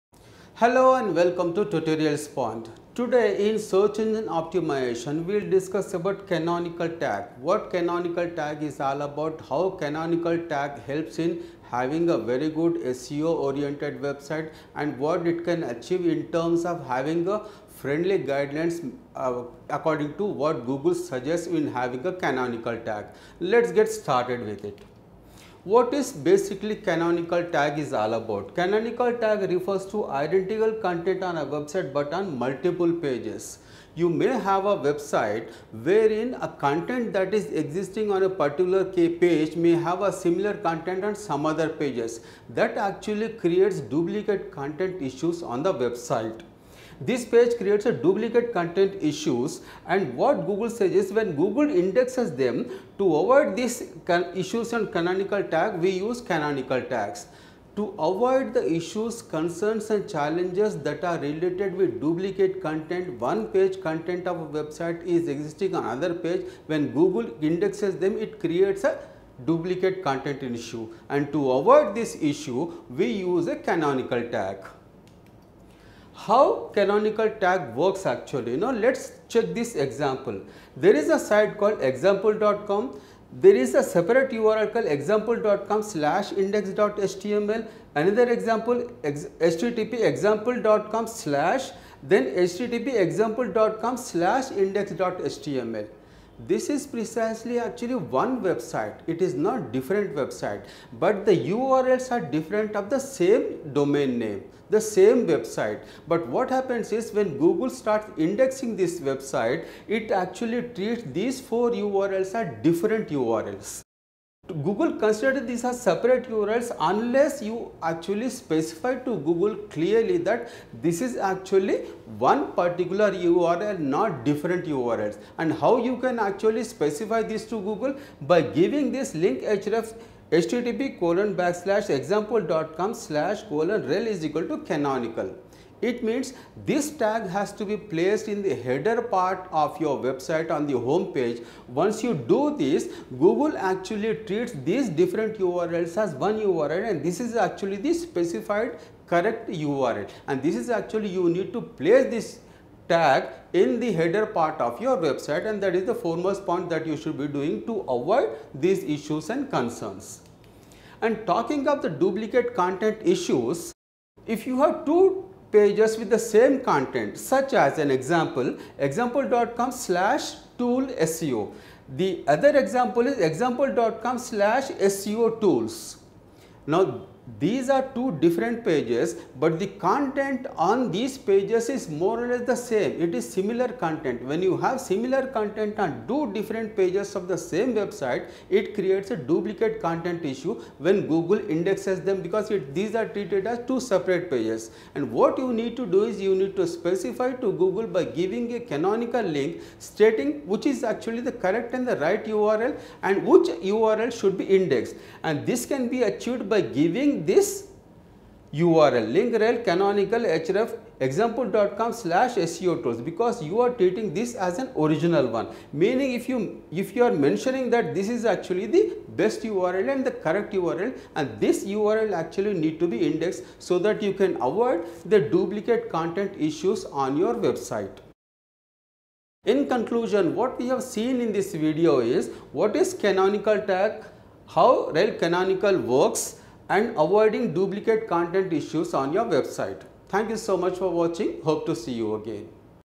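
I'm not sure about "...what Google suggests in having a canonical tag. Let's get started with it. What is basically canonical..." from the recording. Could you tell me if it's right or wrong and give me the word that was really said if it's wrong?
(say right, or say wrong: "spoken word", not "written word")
right.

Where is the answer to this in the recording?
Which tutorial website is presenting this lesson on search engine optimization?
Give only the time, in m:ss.
0:01.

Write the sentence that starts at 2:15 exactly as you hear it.
It means this tag has to be placed in the header part of your website on the home page.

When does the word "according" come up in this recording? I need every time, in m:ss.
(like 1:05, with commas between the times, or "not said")
0:19.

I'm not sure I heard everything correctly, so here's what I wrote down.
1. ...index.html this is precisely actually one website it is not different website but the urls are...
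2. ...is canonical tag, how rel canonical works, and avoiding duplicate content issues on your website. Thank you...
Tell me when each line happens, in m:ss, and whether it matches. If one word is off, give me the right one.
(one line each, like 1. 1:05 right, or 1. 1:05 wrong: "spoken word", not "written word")
1. 1:34 right
2. 3:52 right.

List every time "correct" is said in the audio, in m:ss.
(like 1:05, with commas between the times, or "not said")
2:29, 3:21, 3:40.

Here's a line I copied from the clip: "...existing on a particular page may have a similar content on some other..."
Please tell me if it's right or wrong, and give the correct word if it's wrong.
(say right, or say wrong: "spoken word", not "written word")
right.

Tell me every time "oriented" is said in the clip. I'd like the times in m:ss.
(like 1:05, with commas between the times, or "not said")
0:13.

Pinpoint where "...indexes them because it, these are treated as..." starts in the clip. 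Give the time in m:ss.
3:11.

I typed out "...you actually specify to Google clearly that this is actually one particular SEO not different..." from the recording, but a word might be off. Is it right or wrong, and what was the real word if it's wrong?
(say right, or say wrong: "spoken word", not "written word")
wrong: "URL", not "SEO".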